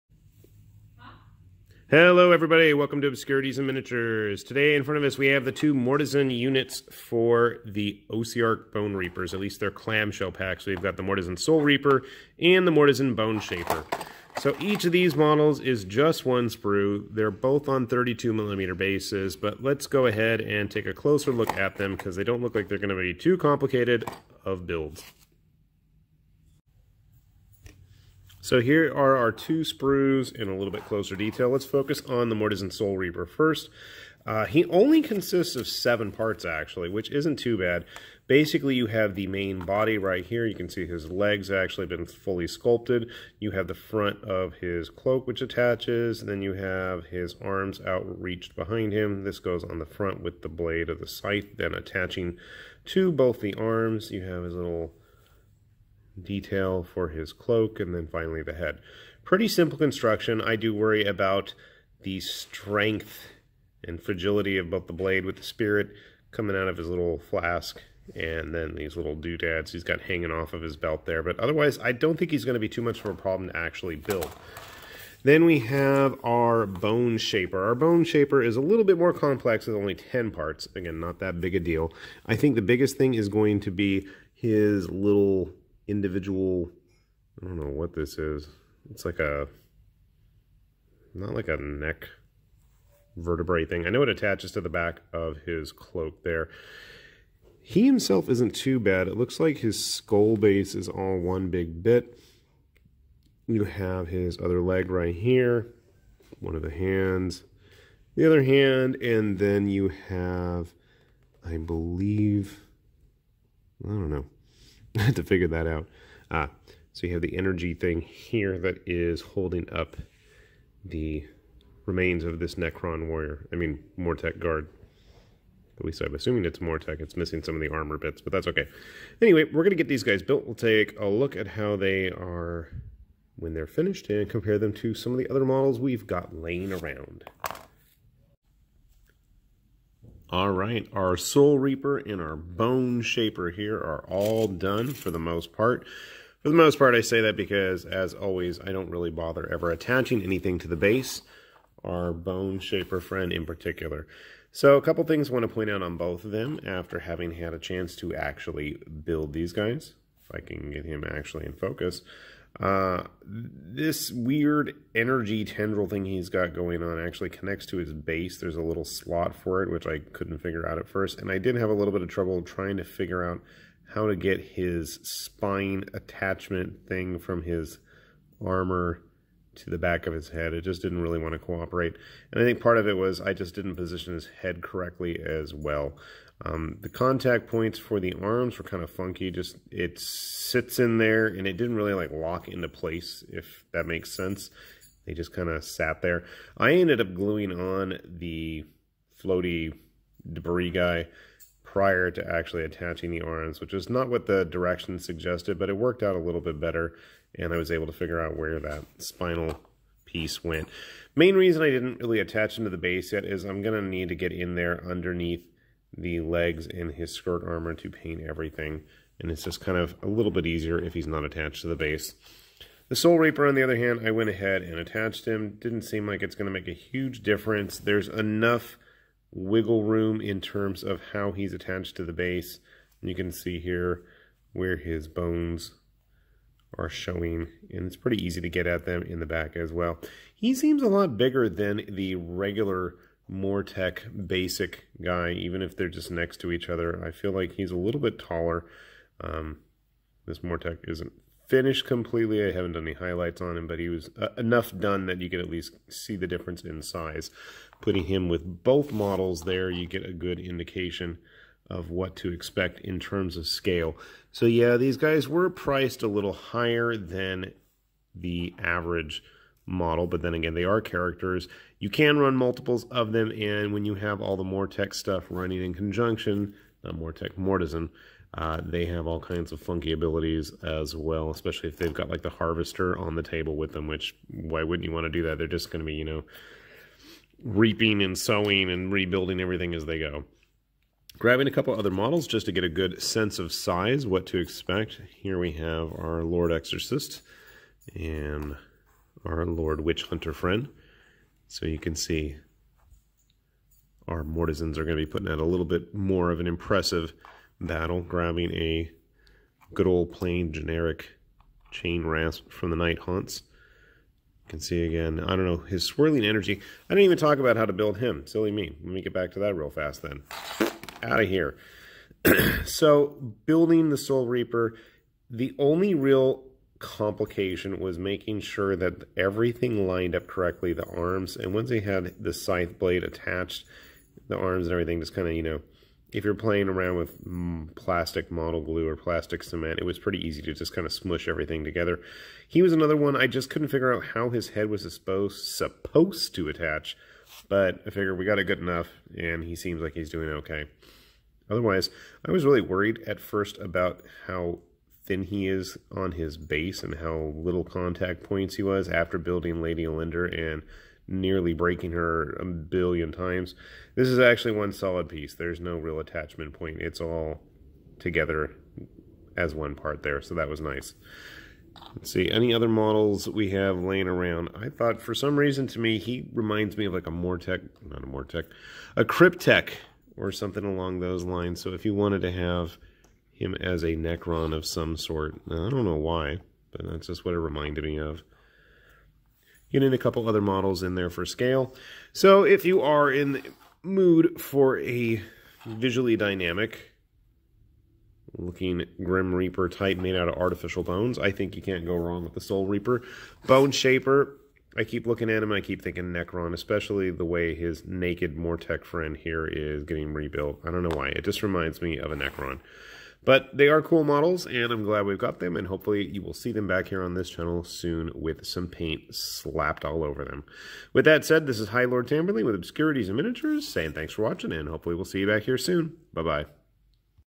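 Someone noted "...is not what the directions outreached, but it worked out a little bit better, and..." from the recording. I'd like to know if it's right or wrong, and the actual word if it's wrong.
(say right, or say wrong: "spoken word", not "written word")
wrong: "suggested", not "outreached".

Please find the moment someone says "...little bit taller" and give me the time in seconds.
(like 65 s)
247 s.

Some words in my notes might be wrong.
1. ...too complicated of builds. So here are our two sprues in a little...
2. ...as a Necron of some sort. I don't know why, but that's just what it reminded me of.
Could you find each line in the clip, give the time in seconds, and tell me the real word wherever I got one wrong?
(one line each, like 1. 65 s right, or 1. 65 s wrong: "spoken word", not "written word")
1. 23 s right
2. 383 s right.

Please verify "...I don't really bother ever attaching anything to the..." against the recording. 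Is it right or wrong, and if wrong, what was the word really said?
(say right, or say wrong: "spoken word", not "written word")
right.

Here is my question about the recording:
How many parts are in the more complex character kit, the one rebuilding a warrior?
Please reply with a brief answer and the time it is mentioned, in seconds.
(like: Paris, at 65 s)
10, at 79 s.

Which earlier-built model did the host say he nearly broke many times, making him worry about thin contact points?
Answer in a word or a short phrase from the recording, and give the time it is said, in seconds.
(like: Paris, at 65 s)
Lady Olynder, at 359 s.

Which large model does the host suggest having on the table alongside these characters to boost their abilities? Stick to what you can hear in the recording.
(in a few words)
The Harvester.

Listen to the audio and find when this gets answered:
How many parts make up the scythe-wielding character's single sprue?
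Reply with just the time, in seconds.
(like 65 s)
35 s.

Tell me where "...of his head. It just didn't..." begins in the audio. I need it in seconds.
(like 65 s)
180 s.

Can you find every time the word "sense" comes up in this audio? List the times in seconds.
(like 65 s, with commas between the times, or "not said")
194 s, 293 s.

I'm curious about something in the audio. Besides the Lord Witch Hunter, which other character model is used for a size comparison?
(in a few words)
Lord Exorcist.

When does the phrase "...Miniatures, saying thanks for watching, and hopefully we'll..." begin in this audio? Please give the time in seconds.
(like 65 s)
423 s.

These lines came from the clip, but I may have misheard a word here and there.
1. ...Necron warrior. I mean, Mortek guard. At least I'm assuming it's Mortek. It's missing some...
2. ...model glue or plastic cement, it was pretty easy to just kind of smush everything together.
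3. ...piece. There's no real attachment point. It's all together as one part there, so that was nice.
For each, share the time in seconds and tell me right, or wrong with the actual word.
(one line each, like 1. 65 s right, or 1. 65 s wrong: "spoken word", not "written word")
1. 122 s right
2. 338 s right
3. 365 s right.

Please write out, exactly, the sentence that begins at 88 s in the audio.
It's like a, not like a neck vertebrae thing.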